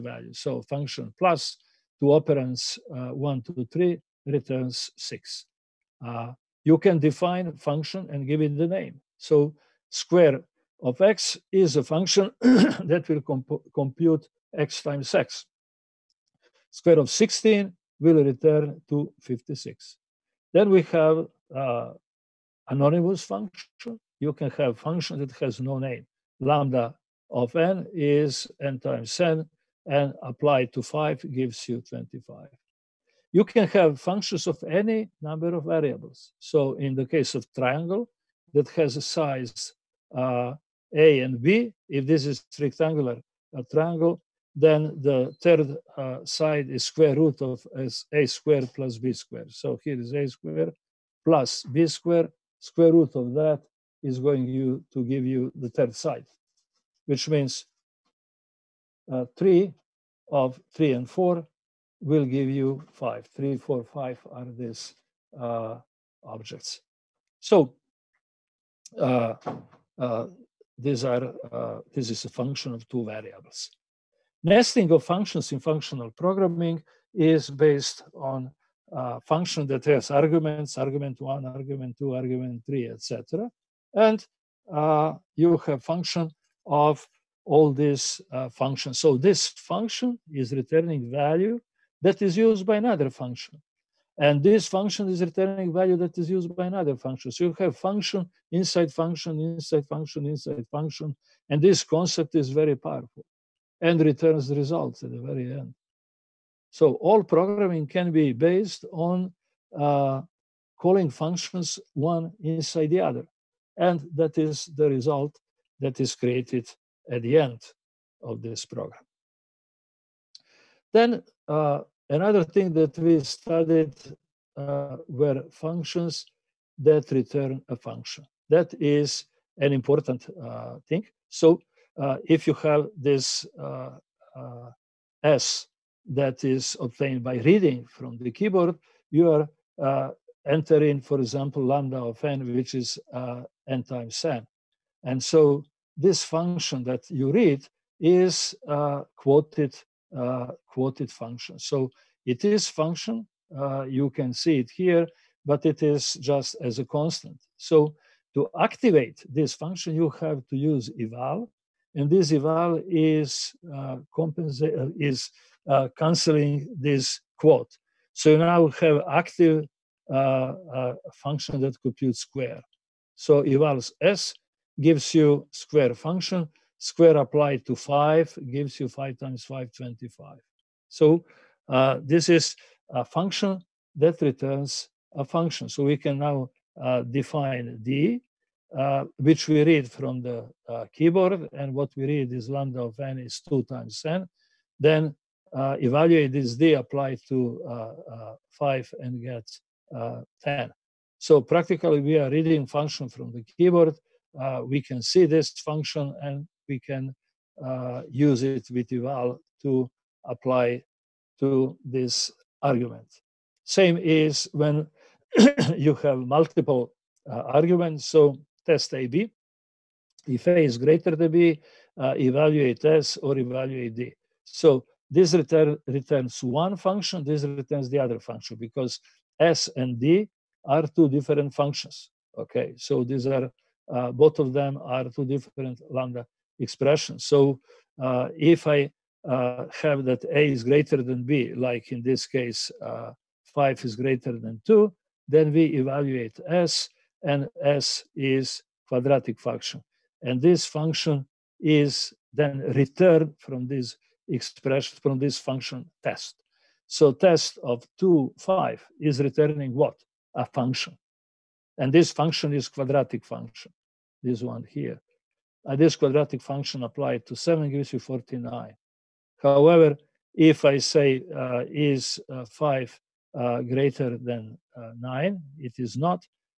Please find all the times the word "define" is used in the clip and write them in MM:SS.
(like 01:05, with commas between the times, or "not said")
00:06, 03:07.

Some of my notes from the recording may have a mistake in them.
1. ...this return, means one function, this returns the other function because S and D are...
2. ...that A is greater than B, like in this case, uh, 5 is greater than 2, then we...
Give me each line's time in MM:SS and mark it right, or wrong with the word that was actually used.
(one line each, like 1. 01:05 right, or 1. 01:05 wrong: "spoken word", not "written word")
1. 03:45 wrong: "returns", not "means"
2. 04:00 right.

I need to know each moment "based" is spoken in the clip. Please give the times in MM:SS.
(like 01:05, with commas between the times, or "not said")
01:17, 01:48.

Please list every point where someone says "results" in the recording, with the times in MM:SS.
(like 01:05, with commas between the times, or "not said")
01:44, 01:54.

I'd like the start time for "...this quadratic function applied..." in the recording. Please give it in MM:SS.
04:25.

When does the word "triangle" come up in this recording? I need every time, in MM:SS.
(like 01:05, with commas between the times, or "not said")
00:37, 00:43.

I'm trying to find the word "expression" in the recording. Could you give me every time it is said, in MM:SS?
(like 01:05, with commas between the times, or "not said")
03:56, 04:14.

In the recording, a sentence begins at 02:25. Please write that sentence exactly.
And so this function that you read is quoted uh, quoted function.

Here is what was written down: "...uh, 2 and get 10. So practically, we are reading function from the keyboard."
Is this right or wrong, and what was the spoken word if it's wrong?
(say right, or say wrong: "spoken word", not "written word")
wrong: "5", not "2".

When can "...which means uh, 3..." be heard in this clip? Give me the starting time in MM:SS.
00:57.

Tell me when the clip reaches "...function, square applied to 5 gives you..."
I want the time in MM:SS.
02:55.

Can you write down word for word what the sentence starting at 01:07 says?
So uh, uh, these are uh, this is a function of two variables.